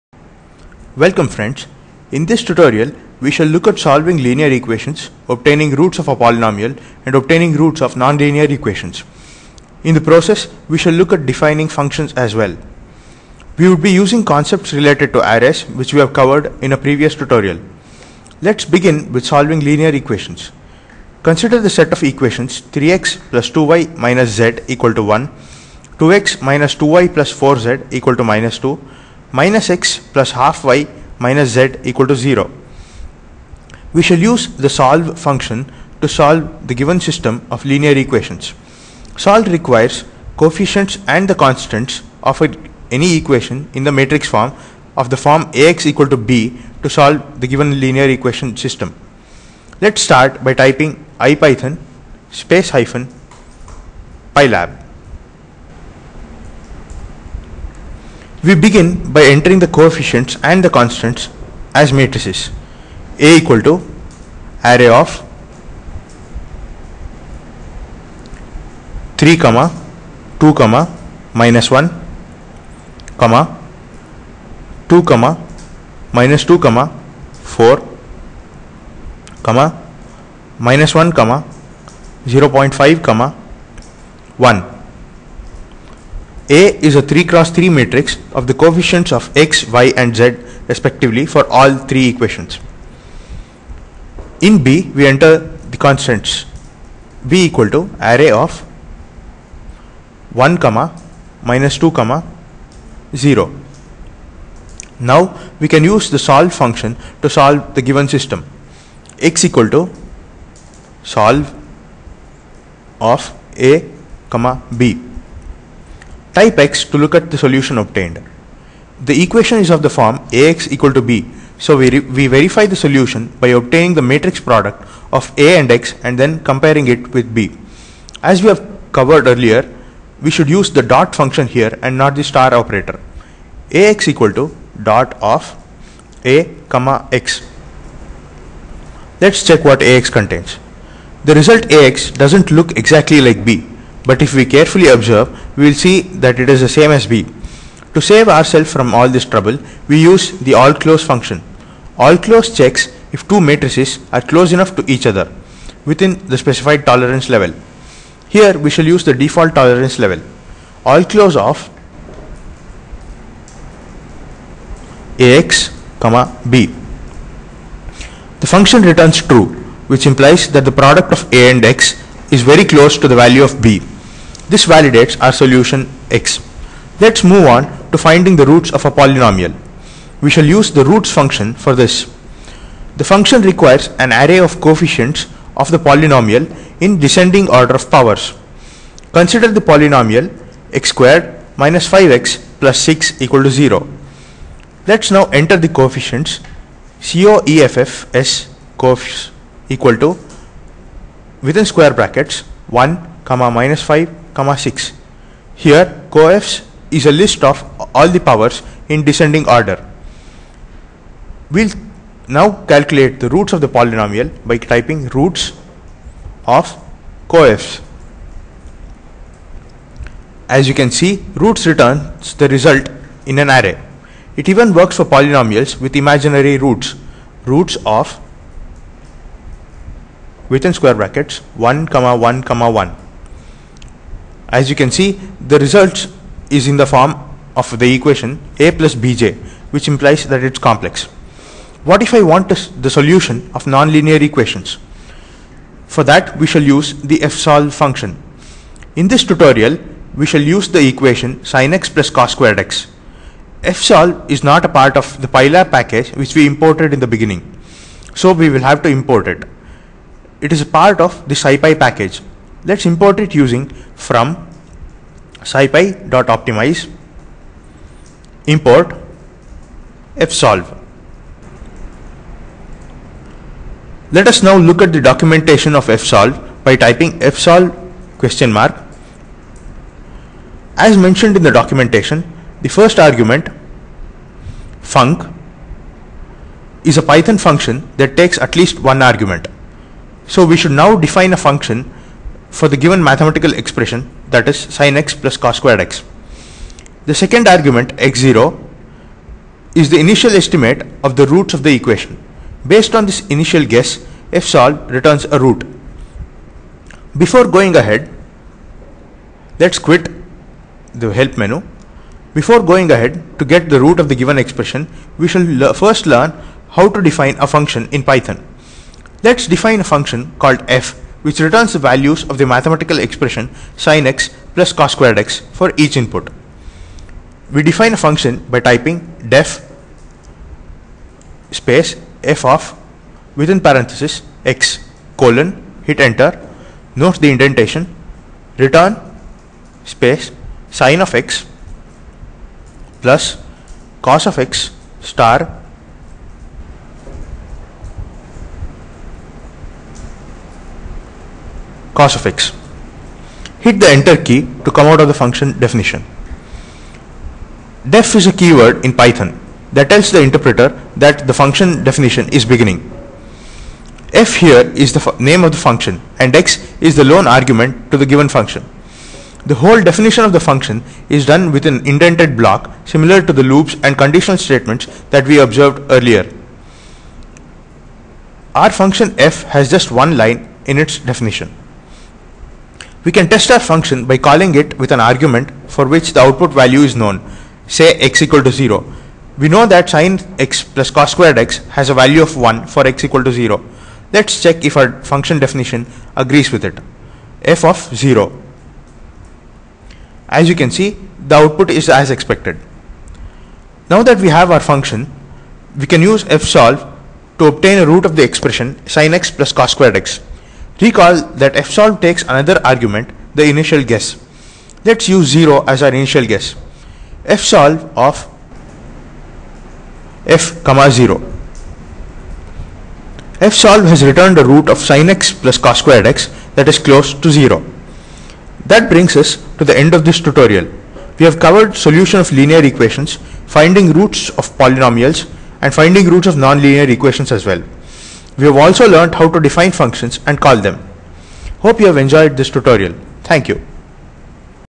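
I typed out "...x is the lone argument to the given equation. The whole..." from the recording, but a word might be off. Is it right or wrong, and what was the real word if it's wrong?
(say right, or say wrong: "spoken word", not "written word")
wrong: "function", not "equation".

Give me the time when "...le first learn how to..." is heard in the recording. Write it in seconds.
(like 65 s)
315 s.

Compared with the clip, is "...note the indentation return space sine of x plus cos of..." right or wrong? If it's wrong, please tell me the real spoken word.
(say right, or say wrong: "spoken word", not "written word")
right.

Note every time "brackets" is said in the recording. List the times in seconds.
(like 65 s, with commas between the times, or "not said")
201 s, 230 s.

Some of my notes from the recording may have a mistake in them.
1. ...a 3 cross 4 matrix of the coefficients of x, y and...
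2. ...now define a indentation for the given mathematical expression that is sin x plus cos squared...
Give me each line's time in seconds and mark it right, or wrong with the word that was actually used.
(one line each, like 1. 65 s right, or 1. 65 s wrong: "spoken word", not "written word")
1. 86 s wrong: "3", not "4"
2. 290 s wrong: "function", not "indentation".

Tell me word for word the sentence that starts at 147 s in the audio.
To save ourselves from all this trouble, we use the all close function.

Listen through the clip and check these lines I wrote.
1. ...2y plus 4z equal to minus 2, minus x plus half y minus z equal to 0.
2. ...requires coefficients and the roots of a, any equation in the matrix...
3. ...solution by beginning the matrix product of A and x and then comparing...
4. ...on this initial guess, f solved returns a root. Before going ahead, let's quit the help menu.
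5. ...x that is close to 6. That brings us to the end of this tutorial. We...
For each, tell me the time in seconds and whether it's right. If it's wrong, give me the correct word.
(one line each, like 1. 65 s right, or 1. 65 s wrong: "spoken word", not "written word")
1. 26 s right
2. 39 s wrong: "constants", not "roots"
3. 122 s wrong: "obtaining", not "beginning"
4. 302 s right
5. 426 s wrong: "0", not "6".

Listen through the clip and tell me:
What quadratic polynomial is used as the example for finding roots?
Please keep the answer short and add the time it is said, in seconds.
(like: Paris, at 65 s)
x^2 - 5x + 6, at 190 s.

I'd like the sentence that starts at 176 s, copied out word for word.
Let's move on to finding the roots of a polynomial.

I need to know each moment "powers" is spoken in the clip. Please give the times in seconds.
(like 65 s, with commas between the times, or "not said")
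187 s, 208 s.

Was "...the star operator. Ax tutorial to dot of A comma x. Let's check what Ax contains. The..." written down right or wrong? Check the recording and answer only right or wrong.
wrong.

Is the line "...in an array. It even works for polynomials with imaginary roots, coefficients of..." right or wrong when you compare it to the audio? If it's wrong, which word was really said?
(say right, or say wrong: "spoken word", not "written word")
wrong: "roots", not "coefficients".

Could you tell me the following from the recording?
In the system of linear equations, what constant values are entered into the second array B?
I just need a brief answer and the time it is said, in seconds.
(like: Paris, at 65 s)
1, -2, 0, at 100 s.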